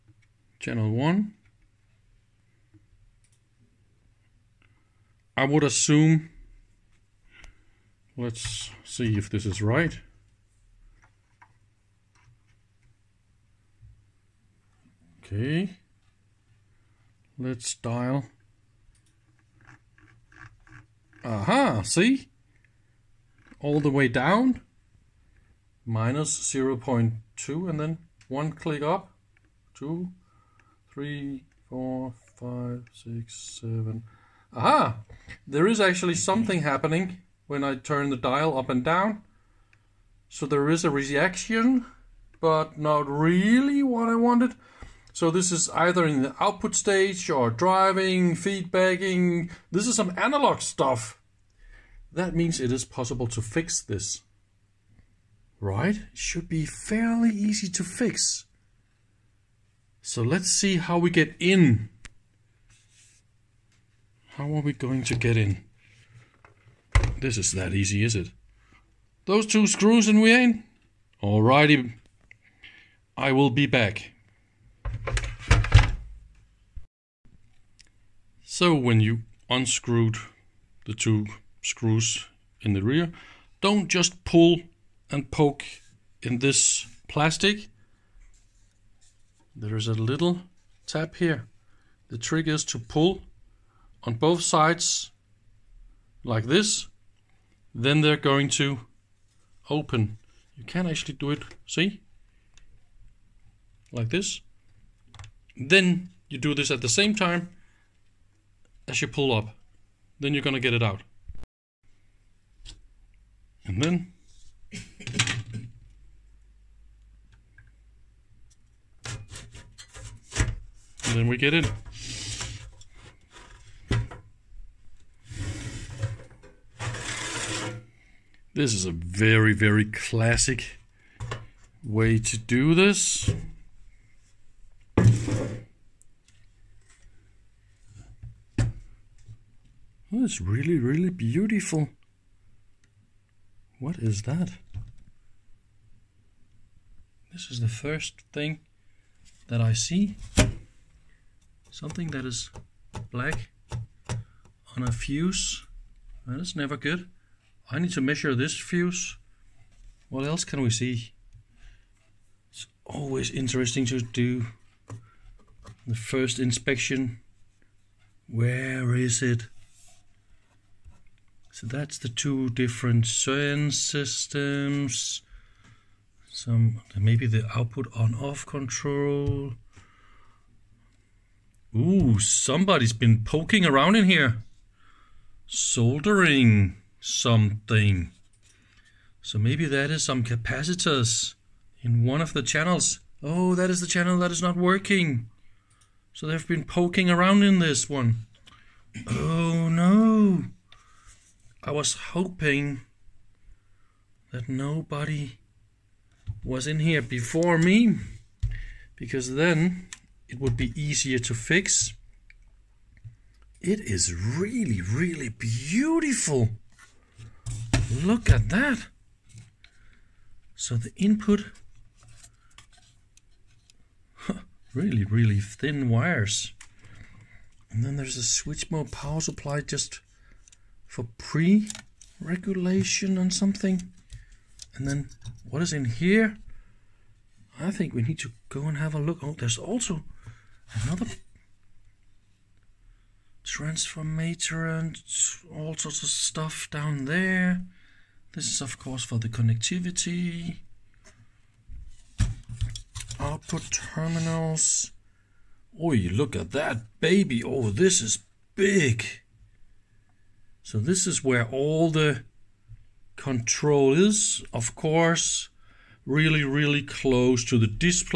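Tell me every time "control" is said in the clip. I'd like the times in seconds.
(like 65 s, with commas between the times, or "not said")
178 s, 263 s.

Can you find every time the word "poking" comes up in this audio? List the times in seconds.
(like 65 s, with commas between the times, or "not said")
183 s, 196 s.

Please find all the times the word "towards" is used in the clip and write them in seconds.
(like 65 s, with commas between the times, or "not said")
not said.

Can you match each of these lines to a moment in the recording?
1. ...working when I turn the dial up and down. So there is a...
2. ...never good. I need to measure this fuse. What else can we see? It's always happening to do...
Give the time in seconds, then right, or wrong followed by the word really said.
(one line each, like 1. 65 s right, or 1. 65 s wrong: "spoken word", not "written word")
1. 36 s wrong: "happening", not "working"
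2. 156 s wrong: "interesting", not "happening".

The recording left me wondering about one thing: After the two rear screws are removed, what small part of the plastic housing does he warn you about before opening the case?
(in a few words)
a little tab.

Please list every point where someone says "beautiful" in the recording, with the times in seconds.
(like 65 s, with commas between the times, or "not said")
141 s, 215 s.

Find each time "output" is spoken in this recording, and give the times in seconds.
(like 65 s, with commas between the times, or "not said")
46 s, 177 s, 253 s.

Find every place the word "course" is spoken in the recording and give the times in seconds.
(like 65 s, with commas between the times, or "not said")
248 s, 264 s.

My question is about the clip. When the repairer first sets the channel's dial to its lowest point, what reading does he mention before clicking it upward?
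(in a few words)
-0.2.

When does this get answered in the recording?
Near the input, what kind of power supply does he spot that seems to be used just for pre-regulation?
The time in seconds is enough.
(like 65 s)
228 s.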